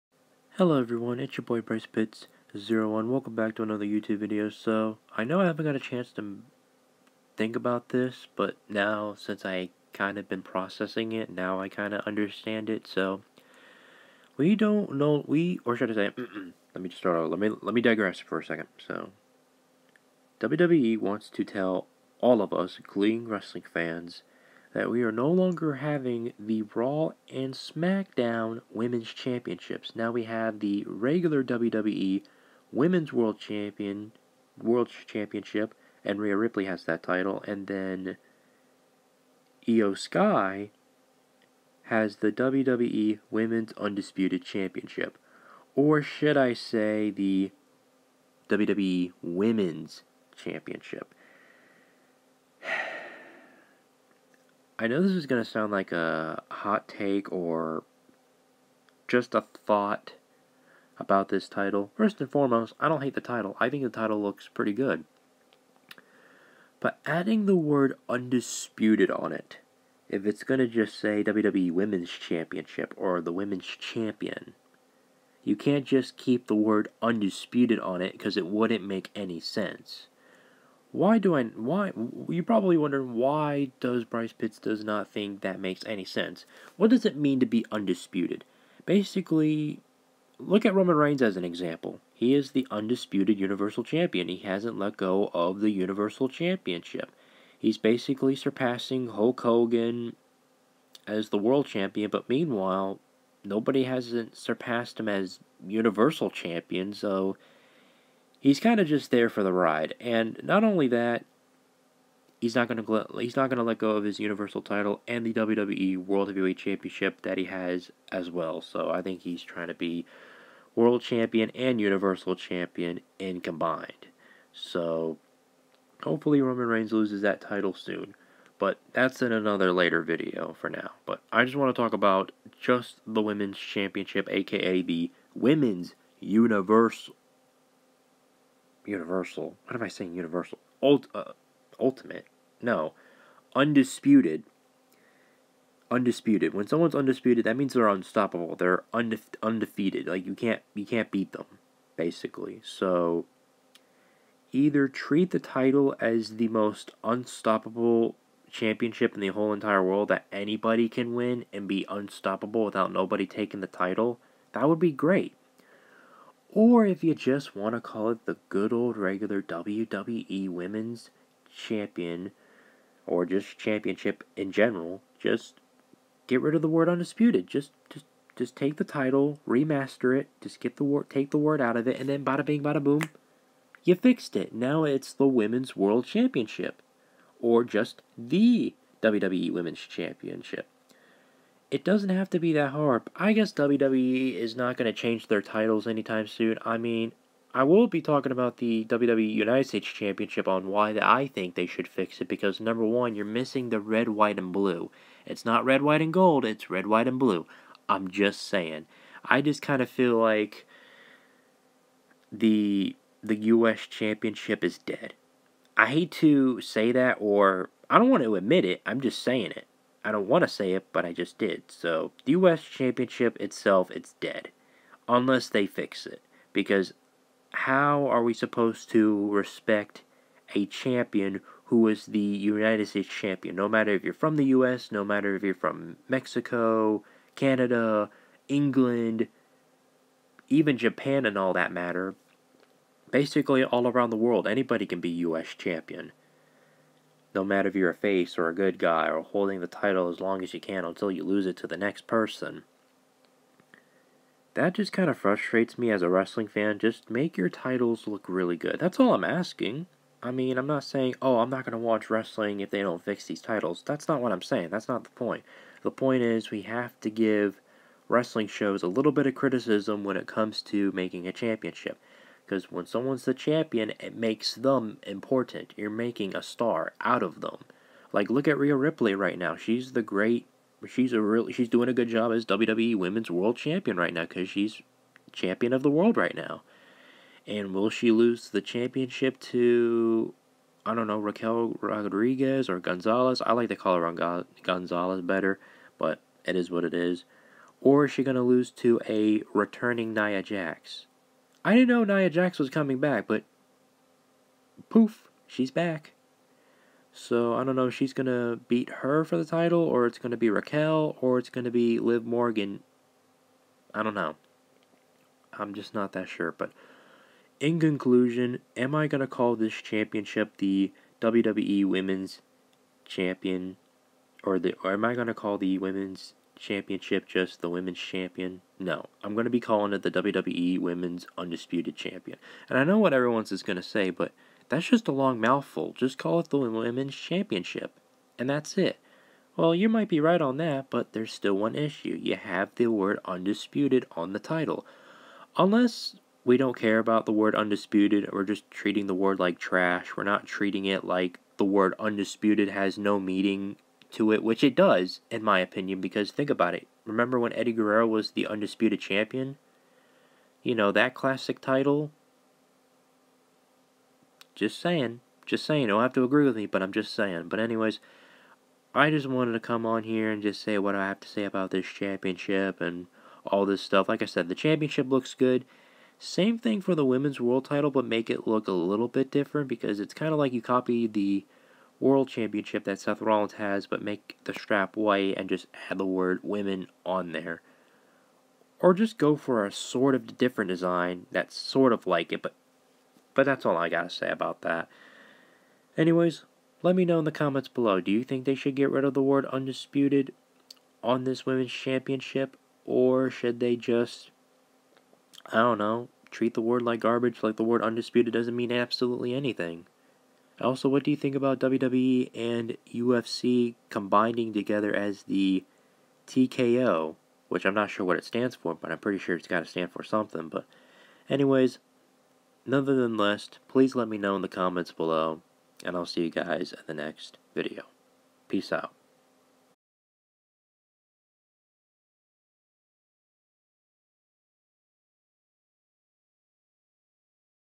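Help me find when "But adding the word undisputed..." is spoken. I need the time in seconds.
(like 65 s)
66 s.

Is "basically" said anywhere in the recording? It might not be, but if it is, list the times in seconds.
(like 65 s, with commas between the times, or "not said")
88 s, 97 s, 151 s, 243 s.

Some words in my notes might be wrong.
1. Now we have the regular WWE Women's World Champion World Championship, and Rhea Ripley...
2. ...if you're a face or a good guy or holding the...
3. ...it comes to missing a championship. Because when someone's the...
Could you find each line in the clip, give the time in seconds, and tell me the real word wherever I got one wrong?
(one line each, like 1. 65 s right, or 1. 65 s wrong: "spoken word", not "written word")
1. 29 s right
2. 247 s right
3. 270 s wrong: "making", not "missing".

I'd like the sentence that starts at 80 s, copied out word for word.
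Why do I why you're probably wondering why does Bryce Pitts does not think that makes any sense?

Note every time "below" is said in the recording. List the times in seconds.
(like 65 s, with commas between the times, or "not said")
397 s, 424 s.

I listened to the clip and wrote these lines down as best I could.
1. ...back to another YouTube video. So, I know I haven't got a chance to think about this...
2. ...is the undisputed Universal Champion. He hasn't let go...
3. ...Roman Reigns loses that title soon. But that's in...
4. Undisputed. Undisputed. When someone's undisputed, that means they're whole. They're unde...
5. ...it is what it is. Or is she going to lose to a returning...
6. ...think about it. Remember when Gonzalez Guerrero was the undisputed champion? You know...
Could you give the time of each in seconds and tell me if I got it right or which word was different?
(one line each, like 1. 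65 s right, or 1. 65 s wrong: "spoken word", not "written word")
1. 3 s right
2. 92 s right
3. 126 s right
4. 143 s wrong: "unstoppable", not "whole"
5. 296 s right
6. 356 s wrong: "Eddie", not "Gonzalez".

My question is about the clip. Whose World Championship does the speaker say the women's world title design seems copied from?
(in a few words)
Seth Rollins.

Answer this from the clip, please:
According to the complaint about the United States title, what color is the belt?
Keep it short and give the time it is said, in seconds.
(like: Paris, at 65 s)
Gold, at 206 s.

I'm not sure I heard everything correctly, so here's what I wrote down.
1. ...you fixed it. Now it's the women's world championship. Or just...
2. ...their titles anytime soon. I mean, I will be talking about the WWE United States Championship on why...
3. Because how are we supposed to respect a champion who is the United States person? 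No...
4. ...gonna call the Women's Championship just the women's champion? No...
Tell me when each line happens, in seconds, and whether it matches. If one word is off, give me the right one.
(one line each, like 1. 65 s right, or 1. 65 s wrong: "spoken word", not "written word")
1. 183 s right
2. 195 s right
3. 226 s wrong: "champion", not "person"
4. 325 s right.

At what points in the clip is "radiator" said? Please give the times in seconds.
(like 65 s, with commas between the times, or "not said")
not said.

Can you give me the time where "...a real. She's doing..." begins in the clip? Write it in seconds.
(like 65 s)
281 s.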